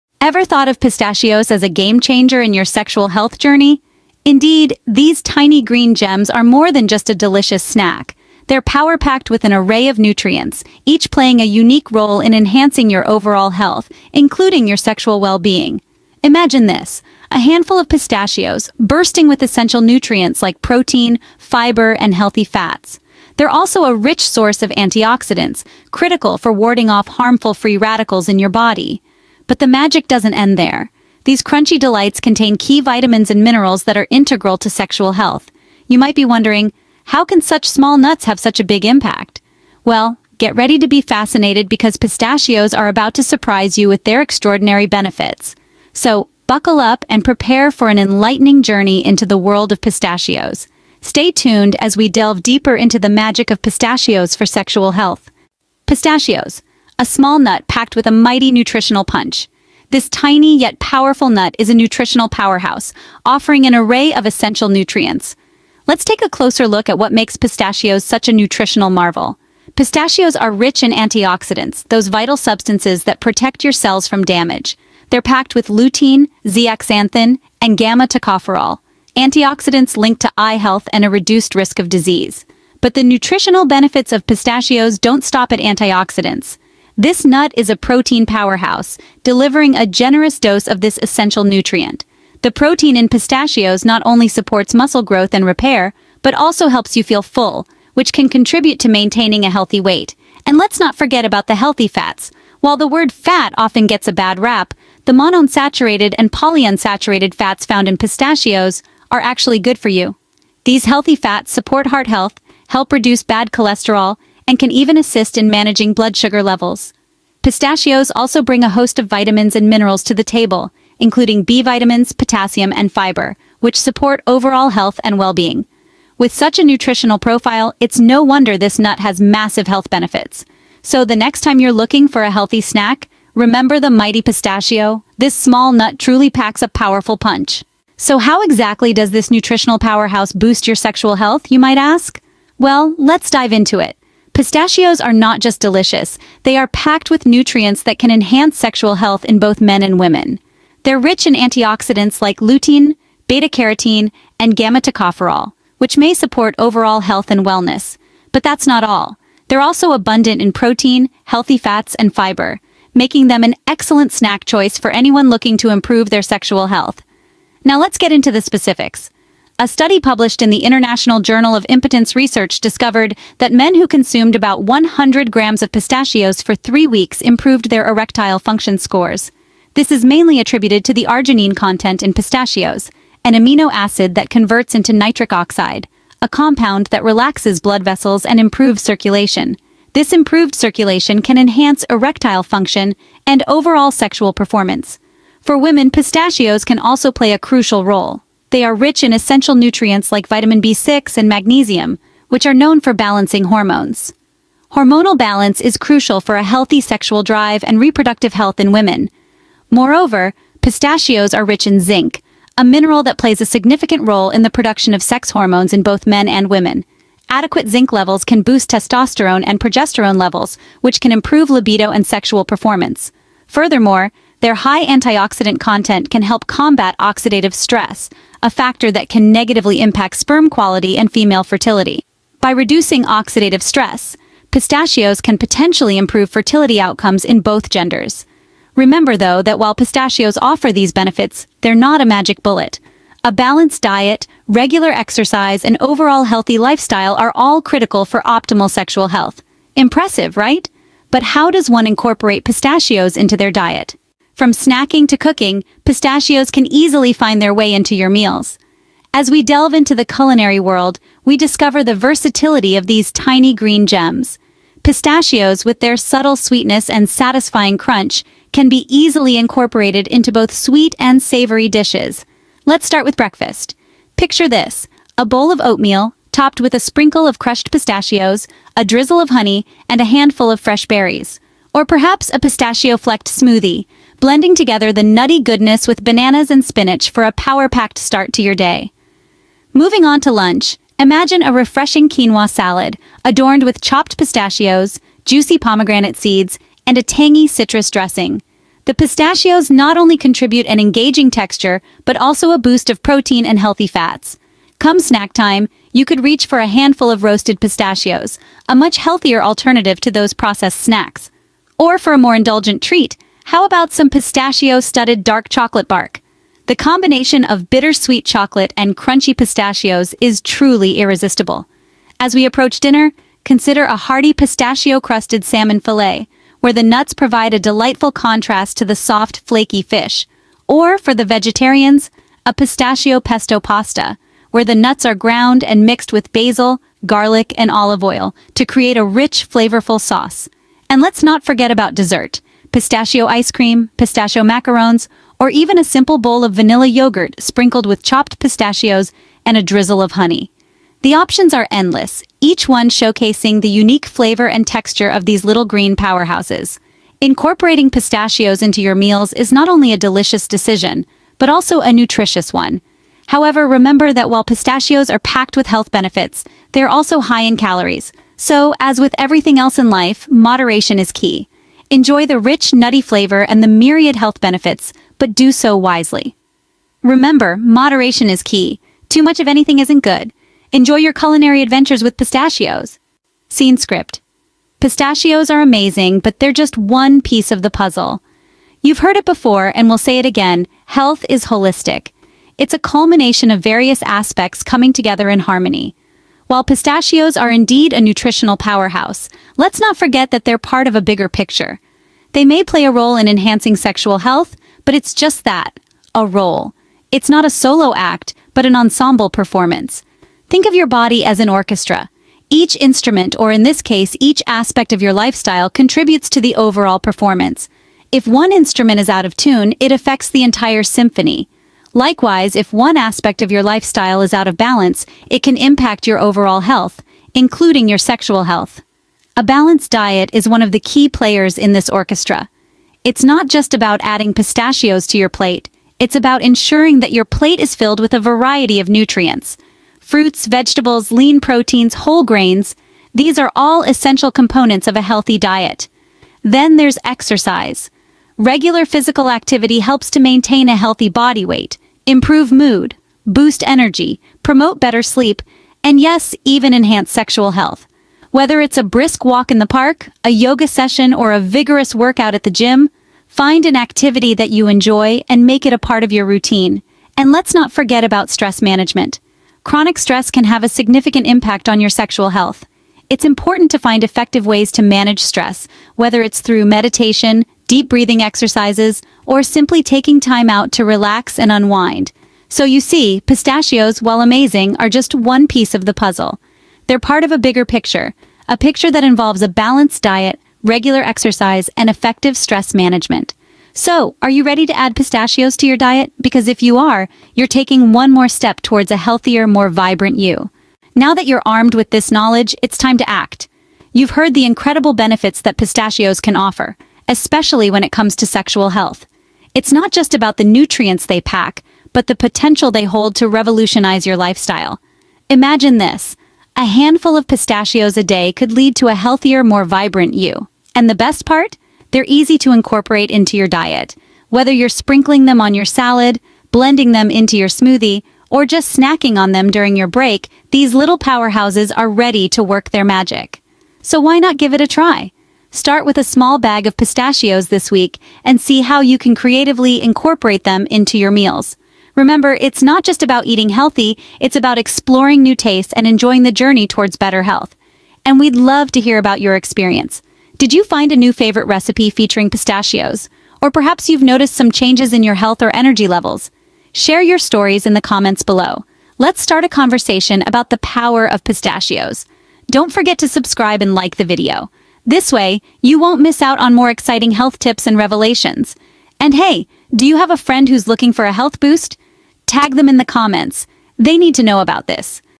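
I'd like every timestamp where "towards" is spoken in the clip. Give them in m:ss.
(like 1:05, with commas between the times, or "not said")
8:18, 9:06.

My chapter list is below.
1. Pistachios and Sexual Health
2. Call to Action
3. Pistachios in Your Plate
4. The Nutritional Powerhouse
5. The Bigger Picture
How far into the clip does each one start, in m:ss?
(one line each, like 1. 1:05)
1. 2:17
2. 8:20
3. 4:14
4. 0:55
5. 6:23.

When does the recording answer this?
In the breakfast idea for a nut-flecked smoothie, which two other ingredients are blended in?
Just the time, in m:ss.
4:46.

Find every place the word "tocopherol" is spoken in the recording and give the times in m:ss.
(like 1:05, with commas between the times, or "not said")
1:17, 2:34.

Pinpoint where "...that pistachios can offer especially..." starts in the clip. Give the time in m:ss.
8:25.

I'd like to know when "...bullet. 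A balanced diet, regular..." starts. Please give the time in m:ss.
4:02.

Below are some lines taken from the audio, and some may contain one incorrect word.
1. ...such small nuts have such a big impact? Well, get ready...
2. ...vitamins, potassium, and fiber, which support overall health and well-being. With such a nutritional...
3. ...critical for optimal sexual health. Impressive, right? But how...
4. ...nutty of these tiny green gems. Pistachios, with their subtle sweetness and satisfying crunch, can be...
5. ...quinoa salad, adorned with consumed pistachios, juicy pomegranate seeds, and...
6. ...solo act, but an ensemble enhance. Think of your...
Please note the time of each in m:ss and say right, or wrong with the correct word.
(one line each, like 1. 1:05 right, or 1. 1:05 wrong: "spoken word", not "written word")
1. 0:37 right
2. 2:01 right
3. 4:07 right
4. 4:21 wrong: "versatility", not "nutty"
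5. 4:52 wrong: "chopped", not "consumed"
6. 6:47 wrong: "performance", not "enhance".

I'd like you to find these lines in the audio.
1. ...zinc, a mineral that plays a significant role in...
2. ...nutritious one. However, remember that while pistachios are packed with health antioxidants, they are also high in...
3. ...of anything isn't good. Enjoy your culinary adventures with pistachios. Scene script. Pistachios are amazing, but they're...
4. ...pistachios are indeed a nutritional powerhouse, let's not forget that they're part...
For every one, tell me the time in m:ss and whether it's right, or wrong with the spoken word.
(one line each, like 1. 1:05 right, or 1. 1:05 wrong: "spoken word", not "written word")
1. 3:31 right
2. 6:01 wrong: "benefits", not "antioxidants"
3. 6:19 right
4. 6:36 right.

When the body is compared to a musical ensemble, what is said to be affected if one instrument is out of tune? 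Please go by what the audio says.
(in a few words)
the entire symphony.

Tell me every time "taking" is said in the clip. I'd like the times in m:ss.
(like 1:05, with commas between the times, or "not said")
7:59, 8:17.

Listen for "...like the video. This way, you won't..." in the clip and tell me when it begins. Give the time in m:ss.
9:23.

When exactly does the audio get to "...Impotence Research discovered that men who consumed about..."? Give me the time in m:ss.
2:51.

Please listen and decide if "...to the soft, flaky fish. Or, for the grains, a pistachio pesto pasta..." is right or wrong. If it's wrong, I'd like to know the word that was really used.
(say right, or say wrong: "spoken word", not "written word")
wrong: "vegetarians", not "grains".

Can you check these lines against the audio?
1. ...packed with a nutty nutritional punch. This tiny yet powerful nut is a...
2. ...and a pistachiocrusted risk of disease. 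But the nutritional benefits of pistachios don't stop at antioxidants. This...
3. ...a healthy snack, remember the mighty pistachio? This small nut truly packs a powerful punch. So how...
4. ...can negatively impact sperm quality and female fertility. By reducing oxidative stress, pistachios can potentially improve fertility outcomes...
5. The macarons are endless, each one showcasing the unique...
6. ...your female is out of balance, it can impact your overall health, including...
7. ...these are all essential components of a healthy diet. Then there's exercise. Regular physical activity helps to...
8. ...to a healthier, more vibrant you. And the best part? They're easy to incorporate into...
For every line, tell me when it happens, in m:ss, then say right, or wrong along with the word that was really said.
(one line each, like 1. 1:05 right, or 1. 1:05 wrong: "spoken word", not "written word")
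1. 0:57 wrong: "mighty", not "nutty"
2. 1:20 wrong: "reduced", not "pistachiocrusted"
3. 2:12 right
4. 3:49 right
5. 5:51 wrong: "options", not "macarons"
6. 7:03 wrong: "lifestyle", not "female"
7. 7:23 right
8. 8:38 right.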